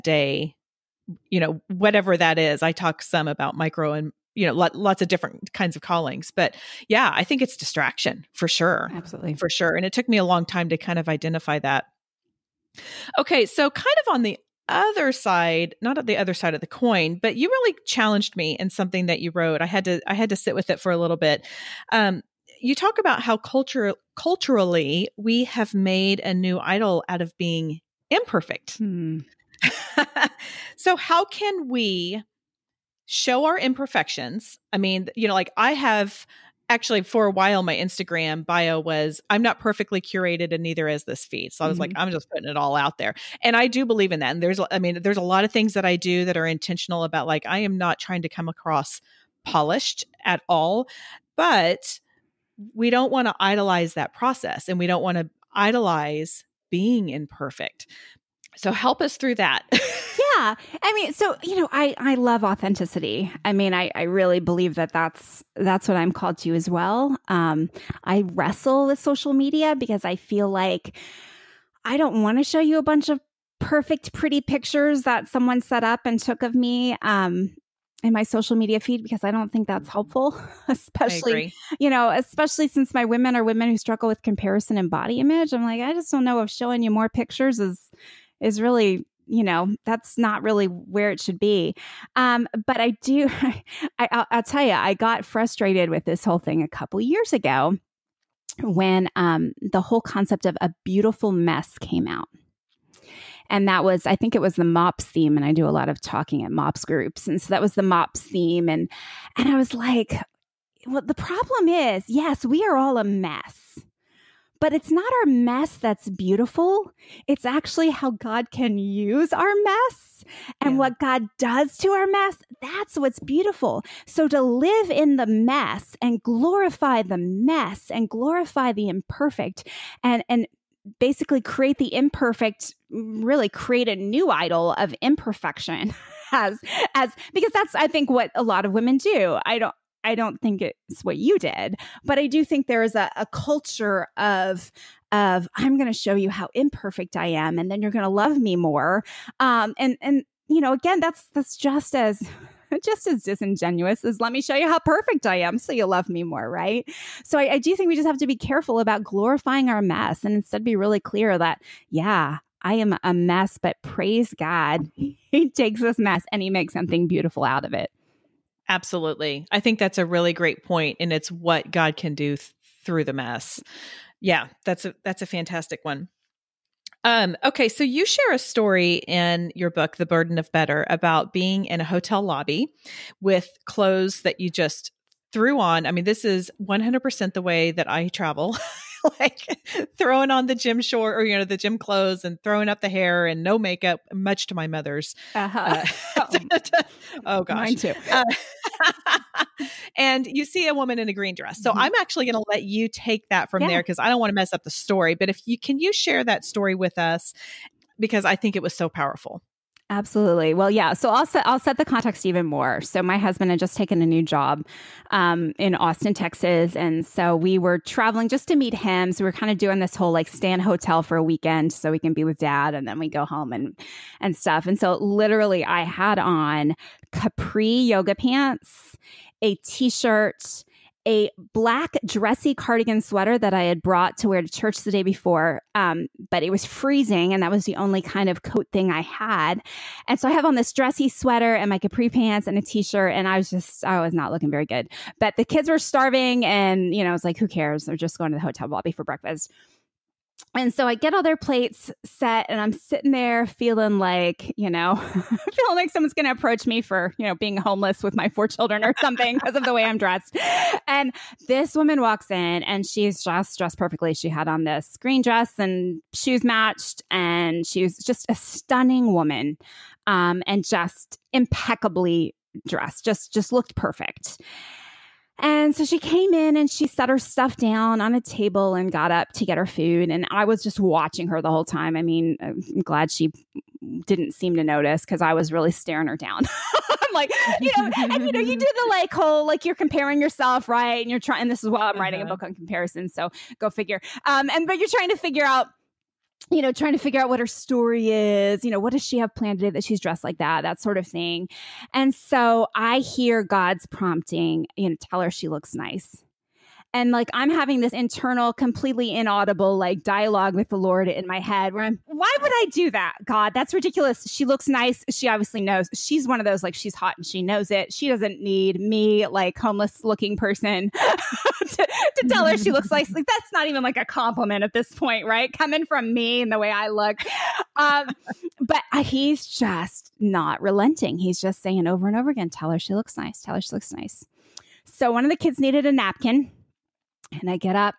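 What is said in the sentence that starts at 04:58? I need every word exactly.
You know, what does she have planned today that she's dressed like that?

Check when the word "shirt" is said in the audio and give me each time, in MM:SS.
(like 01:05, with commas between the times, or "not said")
03:49, 04:02.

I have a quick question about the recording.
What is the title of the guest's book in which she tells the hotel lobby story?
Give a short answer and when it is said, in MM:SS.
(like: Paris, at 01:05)
The Burden of Better, at 02:59.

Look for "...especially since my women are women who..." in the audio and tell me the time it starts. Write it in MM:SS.
01:22.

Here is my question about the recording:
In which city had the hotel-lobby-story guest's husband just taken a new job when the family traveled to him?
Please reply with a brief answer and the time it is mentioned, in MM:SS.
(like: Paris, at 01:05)
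Austin, Texas, at 03:35.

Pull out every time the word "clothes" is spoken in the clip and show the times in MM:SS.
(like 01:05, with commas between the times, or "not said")
03:03, 03:11.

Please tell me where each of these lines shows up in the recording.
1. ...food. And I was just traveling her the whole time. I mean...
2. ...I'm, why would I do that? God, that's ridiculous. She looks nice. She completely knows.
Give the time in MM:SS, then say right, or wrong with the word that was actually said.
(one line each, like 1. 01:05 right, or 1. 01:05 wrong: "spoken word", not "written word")
1. 04:39 wrong: "watching", not "traveling"
2. 05:11 wrong: "obviously", not "completely".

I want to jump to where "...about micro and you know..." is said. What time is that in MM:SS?
00:03.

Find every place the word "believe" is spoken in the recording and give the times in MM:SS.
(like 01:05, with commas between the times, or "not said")
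00:43, 01:04.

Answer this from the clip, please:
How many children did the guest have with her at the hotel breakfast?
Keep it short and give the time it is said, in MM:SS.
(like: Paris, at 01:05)
4, at 04:18.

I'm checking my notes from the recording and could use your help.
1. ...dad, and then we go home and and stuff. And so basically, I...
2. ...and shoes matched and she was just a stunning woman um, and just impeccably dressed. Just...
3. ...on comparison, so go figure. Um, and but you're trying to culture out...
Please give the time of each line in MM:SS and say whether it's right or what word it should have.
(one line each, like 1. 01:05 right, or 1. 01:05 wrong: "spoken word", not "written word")
1. 03:42 wrong: "literally", not "basically"
2. 04:25 right
3. 04:52 wrong: "figure", not "culture".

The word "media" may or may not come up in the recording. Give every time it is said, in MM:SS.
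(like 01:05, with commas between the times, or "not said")
01:09, 01:18.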